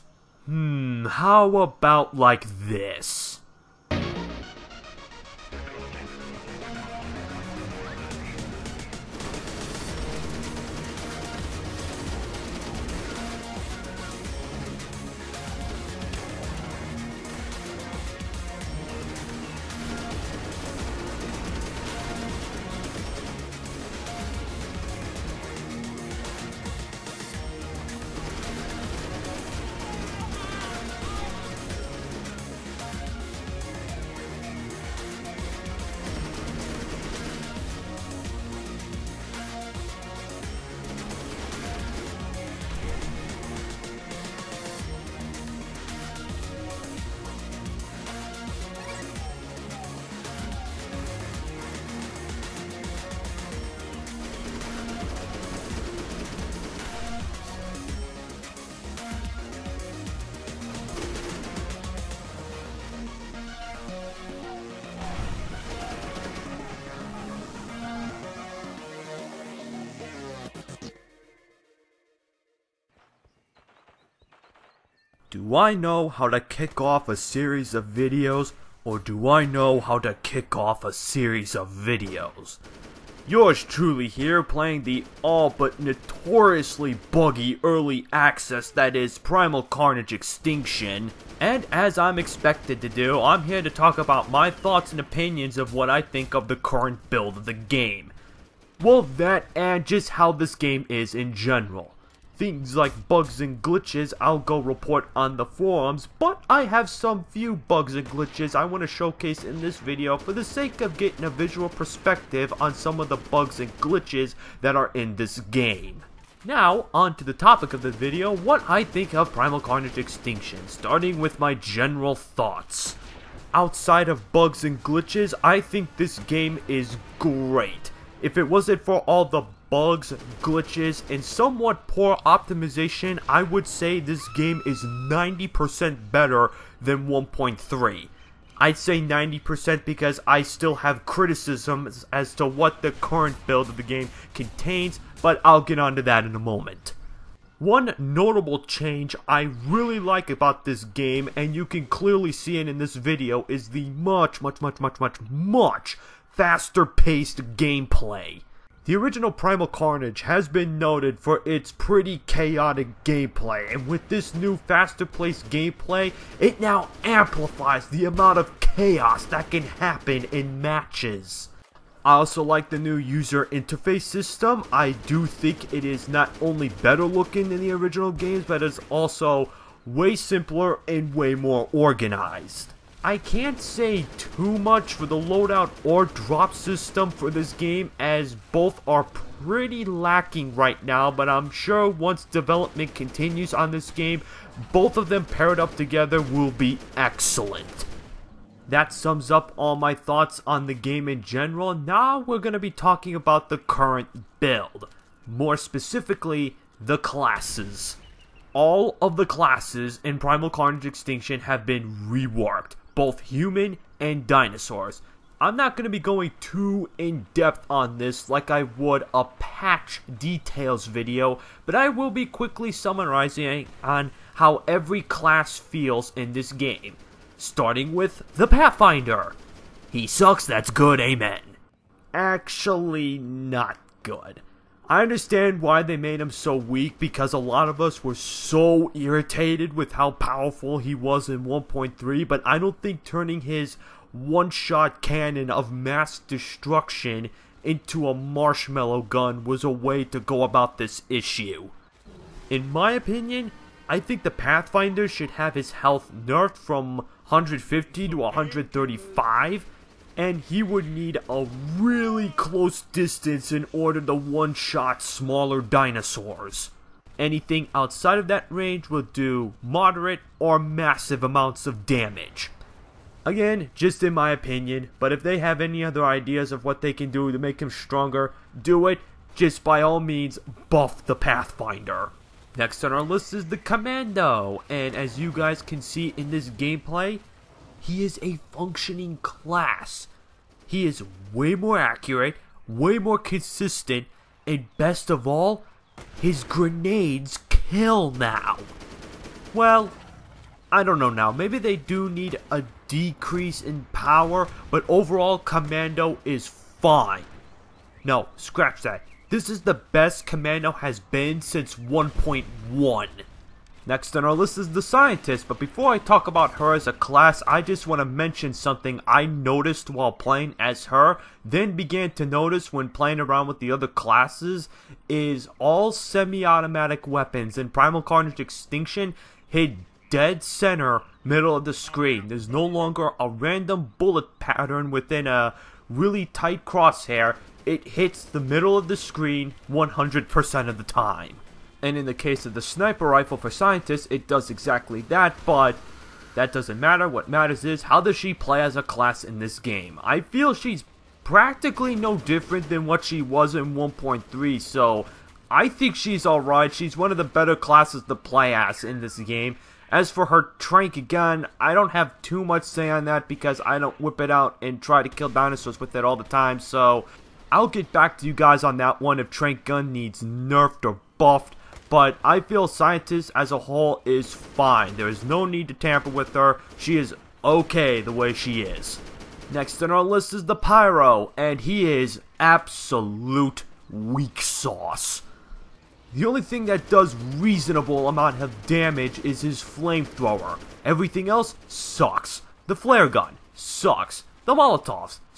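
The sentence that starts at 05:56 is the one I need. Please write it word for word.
She's one of the better classes to play as in this game.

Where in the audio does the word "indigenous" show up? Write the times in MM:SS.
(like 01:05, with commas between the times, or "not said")
not said.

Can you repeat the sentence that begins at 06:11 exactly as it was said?
But I feel scientists as a whole is fine.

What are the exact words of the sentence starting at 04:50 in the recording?
He is way more accurate, way more consistent, and best of all, his grenades kill now.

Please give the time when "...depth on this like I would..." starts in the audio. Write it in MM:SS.
03:37.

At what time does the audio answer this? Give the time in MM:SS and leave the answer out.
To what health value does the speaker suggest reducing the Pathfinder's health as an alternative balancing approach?
04:18.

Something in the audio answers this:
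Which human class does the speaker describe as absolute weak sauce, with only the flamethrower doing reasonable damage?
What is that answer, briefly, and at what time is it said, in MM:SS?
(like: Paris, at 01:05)
Pyro, at 06:20.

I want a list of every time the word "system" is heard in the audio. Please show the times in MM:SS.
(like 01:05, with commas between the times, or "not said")
02:54, 03:06.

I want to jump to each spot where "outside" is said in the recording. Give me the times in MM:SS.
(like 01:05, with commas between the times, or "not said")
02:03, 04:27.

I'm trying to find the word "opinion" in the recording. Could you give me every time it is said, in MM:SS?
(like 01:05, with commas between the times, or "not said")
01:35, 04:12, 04:34.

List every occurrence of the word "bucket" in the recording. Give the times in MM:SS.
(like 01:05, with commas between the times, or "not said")
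not said.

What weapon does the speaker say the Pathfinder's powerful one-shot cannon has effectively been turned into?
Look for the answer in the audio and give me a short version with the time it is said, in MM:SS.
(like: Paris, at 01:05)
marshmallow gun, at 04:08.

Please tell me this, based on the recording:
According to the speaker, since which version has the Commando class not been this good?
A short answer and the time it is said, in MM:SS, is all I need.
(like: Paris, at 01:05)
1.1, at 05:11.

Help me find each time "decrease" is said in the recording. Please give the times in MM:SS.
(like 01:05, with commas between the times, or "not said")
05:02.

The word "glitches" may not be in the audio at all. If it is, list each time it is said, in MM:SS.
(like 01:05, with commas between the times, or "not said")
01:43, 01:48, 01:53, 02:04, 02:10.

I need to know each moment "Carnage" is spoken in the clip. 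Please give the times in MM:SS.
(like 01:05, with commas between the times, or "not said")
01:29, 01:59, 02:39, 03:30, 05:28.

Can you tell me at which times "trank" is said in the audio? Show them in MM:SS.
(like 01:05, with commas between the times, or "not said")
06:00, 06:09.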